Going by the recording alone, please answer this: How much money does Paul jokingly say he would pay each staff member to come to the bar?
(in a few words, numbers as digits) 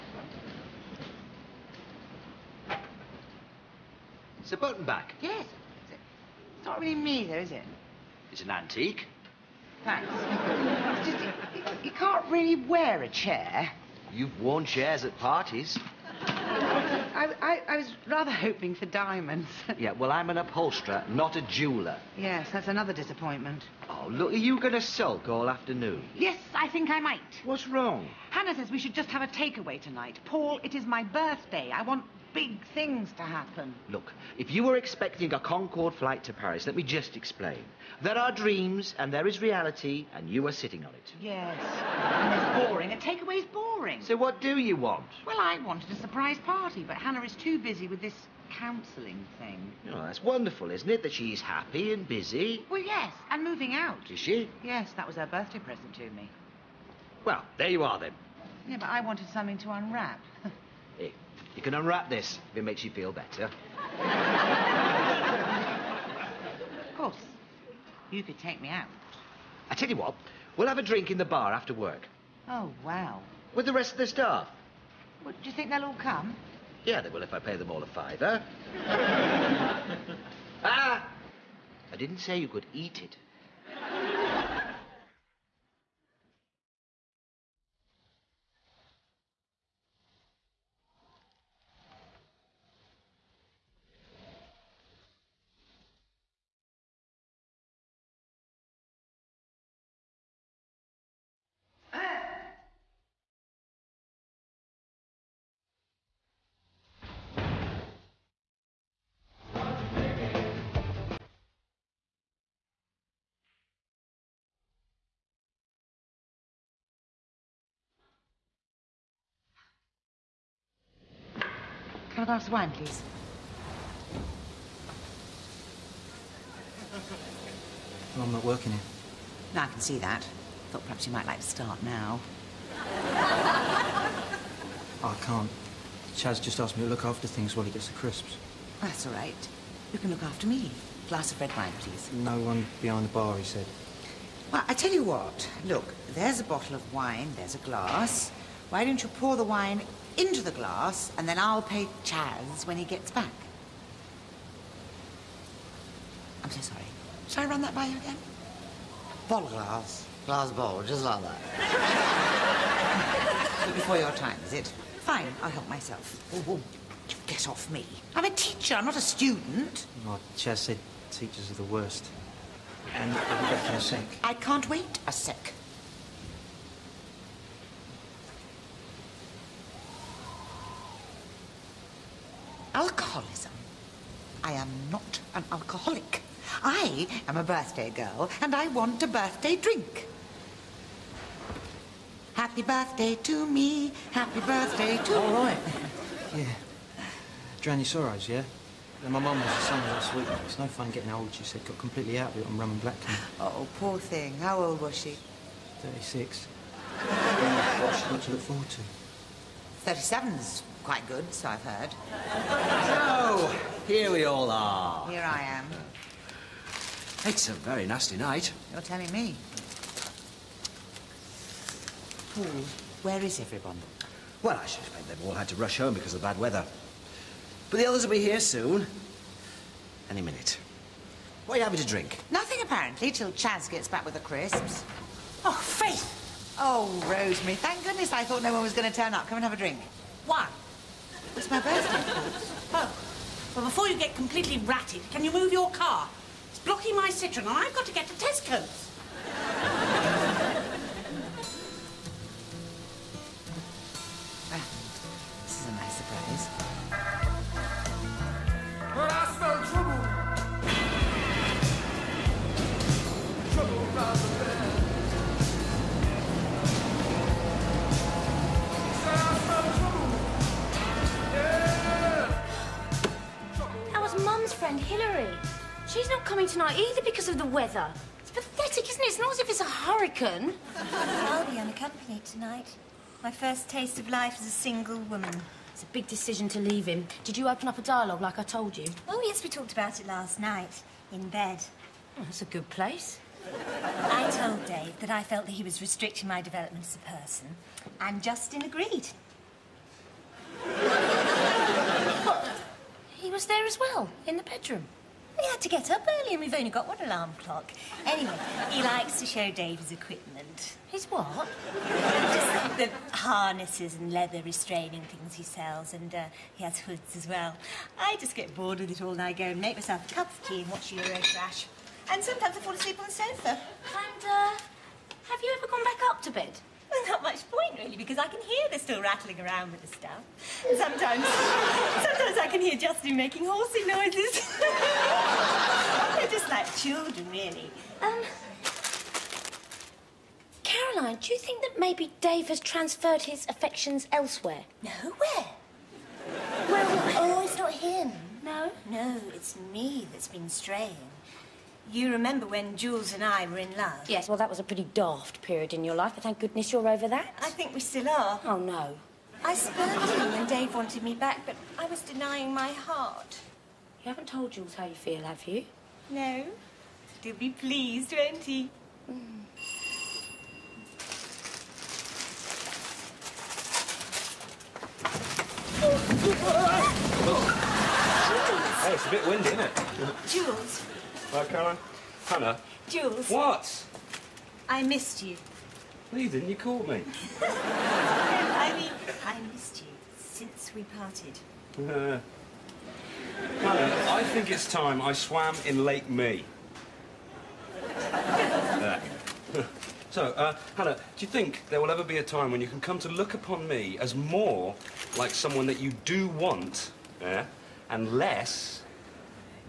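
5 pounds.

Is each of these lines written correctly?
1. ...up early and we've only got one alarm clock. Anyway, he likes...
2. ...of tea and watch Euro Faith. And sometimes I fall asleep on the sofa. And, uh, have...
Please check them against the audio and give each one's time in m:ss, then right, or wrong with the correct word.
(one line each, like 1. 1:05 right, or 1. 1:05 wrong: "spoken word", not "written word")
1. 5:05 right
2. 5:20 wrong: "Trash", not "Faith".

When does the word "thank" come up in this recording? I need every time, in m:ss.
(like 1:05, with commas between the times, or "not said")
0:09, 3:57, 5:56.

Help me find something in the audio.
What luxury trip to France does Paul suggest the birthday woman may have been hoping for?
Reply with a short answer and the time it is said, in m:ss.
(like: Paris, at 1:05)
Concorde flight to Paris, at 0:35.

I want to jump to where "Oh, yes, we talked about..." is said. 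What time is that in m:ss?
4:49.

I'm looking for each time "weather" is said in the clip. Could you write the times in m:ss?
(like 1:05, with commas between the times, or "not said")
3:46, 4:37.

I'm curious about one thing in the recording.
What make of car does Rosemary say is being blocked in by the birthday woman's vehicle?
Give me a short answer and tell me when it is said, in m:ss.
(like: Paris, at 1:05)
Citroen, at 4:07.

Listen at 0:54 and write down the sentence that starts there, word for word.
Yes, that was her birthday present to me.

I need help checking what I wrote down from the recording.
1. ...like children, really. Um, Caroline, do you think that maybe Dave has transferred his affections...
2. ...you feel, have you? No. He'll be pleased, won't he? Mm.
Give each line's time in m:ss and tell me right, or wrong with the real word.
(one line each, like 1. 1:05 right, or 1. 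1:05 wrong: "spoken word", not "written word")
1. 5:36 right
2. 6:04 right.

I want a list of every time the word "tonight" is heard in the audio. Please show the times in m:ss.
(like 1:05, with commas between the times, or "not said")
0:29, 4:42.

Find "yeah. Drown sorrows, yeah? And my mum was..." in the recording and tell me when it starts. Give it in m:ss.
3:16.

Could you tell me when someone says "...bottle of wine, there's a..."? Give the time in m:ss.
2:26.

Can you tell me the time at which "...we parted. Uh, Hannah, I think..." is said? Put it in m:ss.
6:30.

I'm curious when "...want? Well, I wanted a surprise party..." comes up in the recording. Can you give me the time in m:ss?
0:44.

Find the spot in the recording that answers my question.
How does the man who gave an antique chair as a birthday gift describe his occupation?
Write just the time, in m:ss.
0:20.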